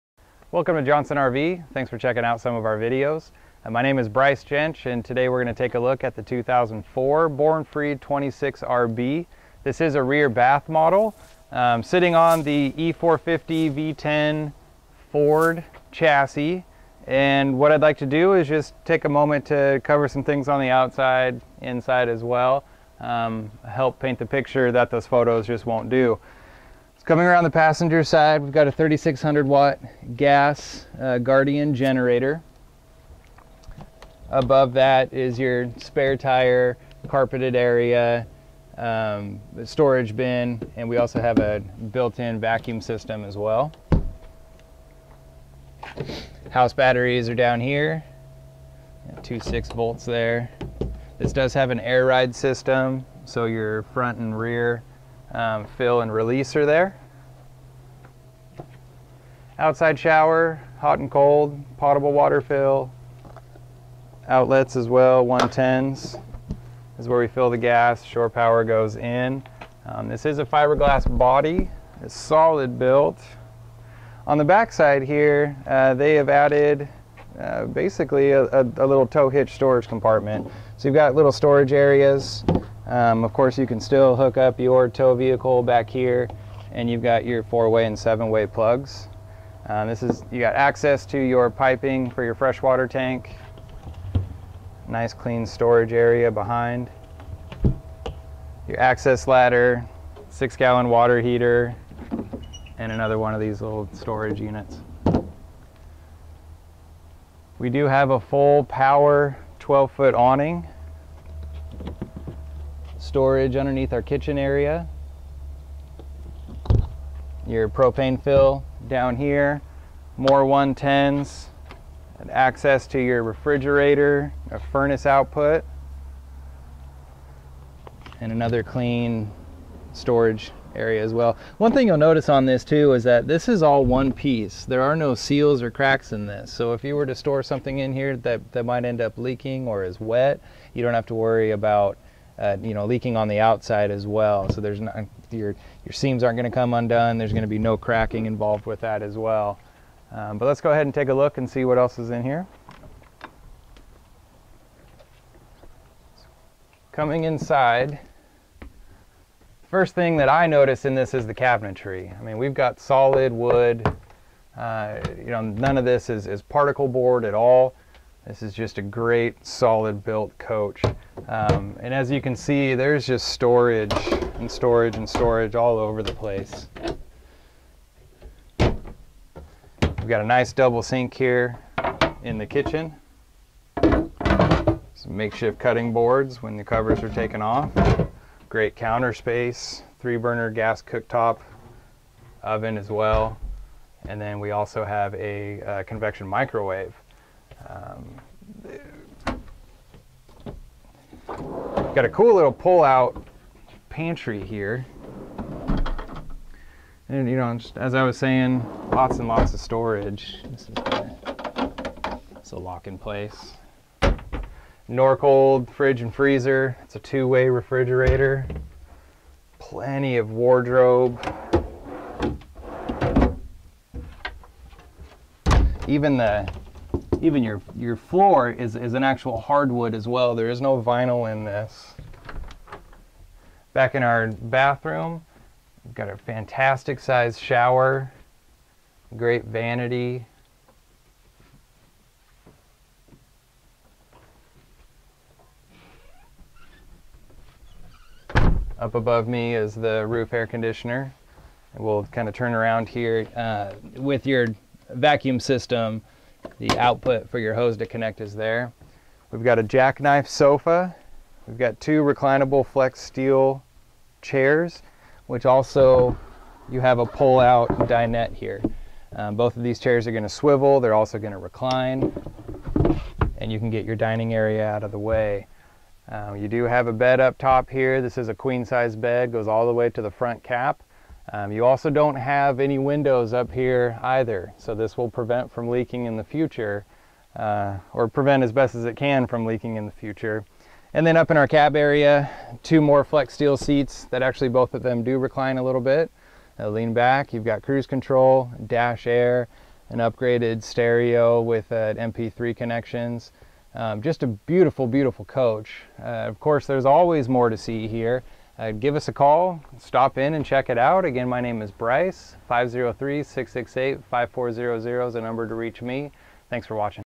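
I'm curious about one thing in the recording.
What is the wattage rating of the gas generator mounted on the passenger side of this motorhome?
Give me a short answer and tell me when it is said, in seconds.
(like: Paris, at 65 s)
3600 watt, at 28 s.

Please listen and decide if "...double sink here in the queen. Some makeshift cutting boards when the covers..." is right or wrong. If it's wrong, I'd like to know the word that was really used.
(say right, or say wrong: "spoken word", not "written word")
wrong: "kitchen", not "queen".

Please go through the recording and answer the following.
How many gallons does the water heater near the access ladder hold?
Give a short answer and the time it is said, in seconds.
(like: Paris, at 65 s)
6, at 100 s.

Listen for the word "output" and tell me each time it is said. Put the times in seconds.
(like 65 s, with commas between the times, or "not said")
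125 s, 256 s.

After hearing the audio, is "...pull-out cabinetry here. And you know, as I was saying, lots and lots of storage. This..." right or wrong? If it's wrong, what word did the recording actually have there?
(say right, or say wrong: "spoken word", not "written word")
wrong: "pantry", not "cabinetry".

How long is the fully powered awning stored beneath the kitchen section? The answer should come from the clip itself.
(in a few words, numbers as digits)
12 feet.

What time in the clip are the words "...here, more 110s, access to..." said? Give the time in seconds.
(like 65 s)
119 s.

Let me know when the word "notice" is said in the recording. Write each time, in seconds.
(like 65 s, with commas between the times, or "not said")
131 s, 160 s.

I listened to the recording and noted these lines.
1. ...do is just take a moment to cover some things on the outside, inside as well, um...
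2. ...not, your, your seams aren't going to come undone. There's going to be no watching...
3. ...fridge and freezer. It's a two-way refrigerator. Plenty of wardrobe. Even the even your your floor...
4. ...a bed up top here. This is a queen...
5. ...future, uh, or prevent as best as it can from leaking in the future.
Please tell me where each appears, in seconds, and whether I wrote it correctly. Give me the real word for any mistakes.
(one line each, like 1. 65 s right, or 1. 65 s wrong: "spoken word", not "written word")
1. 18 s right
2. 144 s wrong: "cracking", not "watching"
3. 215 s right
4. 276 s right
5. 286 s right.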